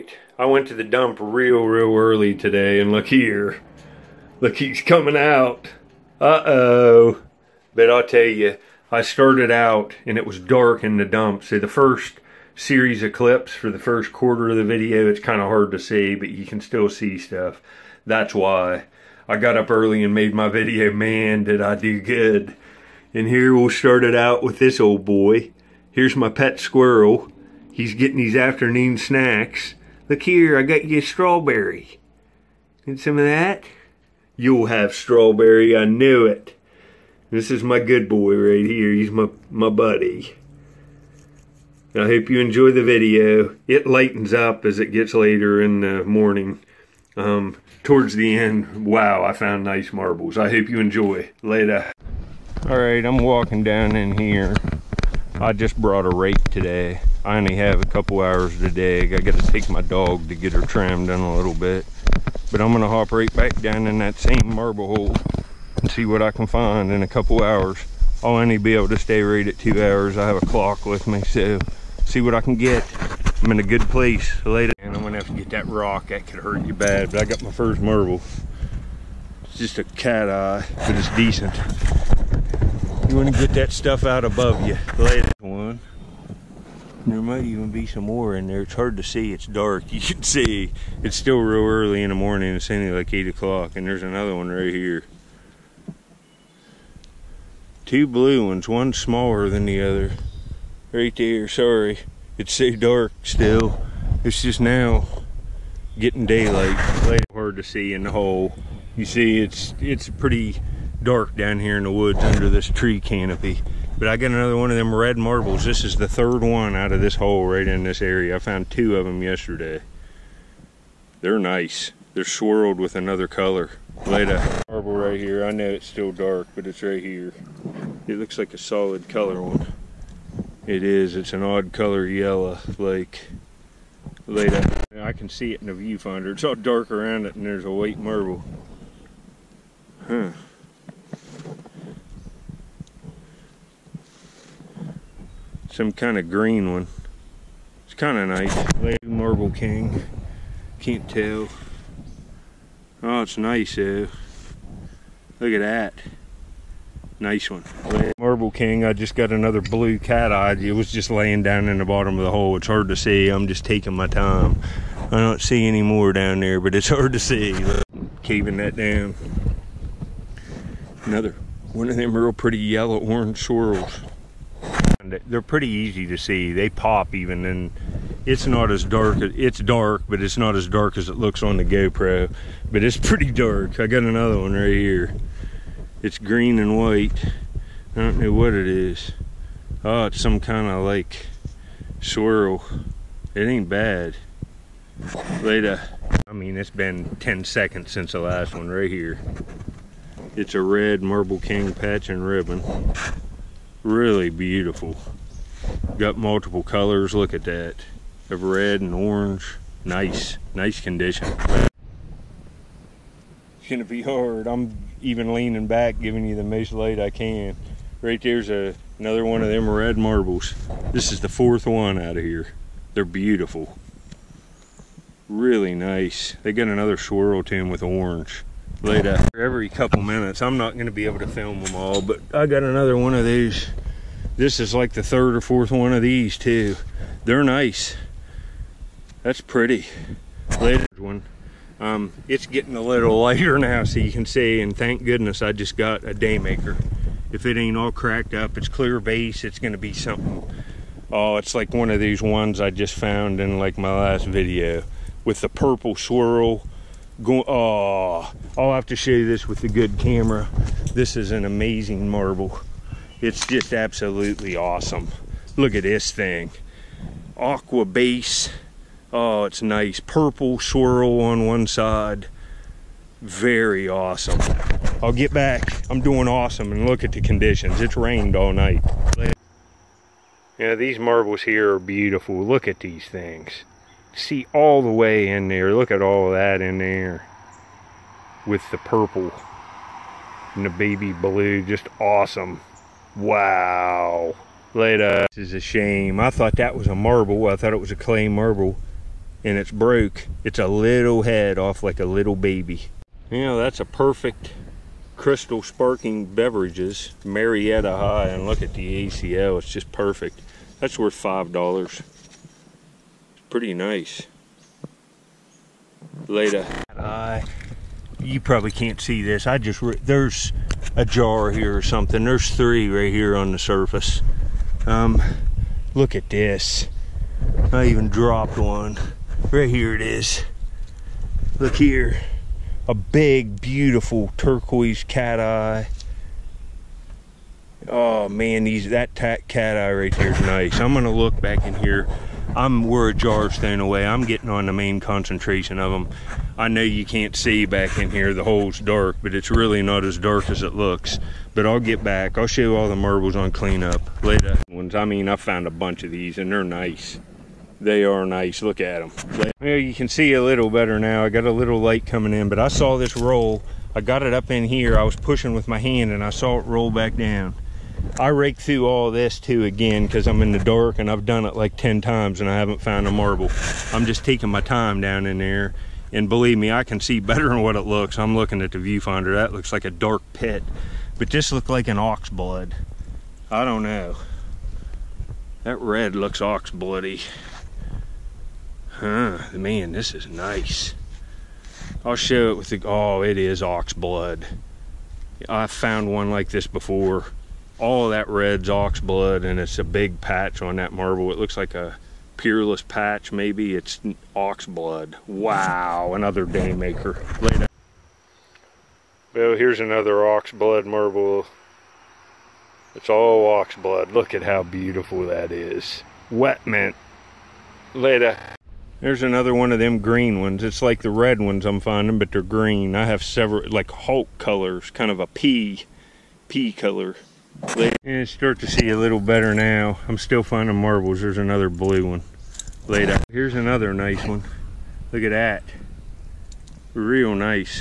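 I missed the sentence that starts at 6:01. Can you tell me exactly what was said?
I got a little light coming in, but I saw this roll.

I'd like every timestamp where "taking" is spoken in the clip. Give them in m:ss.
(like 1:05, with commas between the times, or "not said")
2:43, 6:14.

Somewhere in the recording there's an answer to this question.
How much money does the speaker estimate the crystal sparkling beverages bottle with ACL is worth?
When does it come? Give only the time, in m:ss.
5:11.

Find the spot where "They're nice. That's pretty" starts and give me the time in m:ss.
3:57.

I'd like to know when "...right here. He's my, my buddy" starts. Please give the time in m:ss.
0:38.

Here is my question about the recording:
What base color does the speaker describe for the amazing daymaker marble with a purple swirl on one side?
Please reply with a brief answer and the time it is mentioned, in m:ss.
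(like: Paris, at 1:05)
Aqua, at 4:27.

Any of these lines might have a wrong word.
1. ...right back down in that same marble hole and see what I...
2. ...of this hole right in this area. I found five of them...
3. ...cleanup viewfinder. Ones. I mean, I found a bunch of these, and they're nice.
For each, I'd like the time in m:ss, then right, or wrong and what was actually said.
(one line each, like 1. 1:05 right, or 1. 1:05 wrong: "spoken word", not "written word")
1. 1:03 right
2. 1:56 wrong: "two", not "five"
3. 5:53 wrong: "later", not "viewfinder".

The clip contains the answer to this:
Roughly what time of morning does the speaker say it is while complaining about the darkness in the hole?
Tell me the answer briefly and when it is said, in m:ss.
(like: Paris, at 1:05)
8 o'clock, at 1:33.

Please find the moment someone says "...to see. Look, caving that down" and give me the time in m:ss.
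2:47.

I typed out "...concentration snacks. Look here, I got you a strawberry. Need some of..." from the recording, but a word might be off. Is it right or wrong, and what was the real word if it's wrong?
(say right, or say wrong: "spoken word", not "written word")
wrong: "afternoon", not "concentration".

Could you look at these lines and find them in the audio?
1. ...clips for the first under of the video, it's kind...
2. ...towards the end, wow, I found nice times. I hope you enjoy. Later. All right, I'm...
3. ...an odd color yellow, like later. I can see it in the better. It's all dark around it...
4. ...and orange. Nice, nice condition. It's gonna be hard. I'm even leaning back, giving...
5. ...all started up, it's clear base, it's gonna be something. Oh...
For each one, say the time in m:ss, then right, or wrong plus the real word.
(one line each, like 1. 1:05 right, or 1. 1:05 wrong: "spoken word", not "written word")
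1. 0:13 wrong: "quarter", not "under"
2. 0:47 wrong: "marbles", not "times"
3. 2:11 wrong: "viewfinder", not "better"
4. 3:28 right
5. 4:07 wrong: "cracked", not "started".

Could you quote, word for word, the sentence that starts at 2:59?
It's dark, but it's not as dark as it looks on the GoPro.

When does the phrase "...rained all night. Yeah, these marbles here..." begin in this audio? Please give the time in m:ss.
4:37.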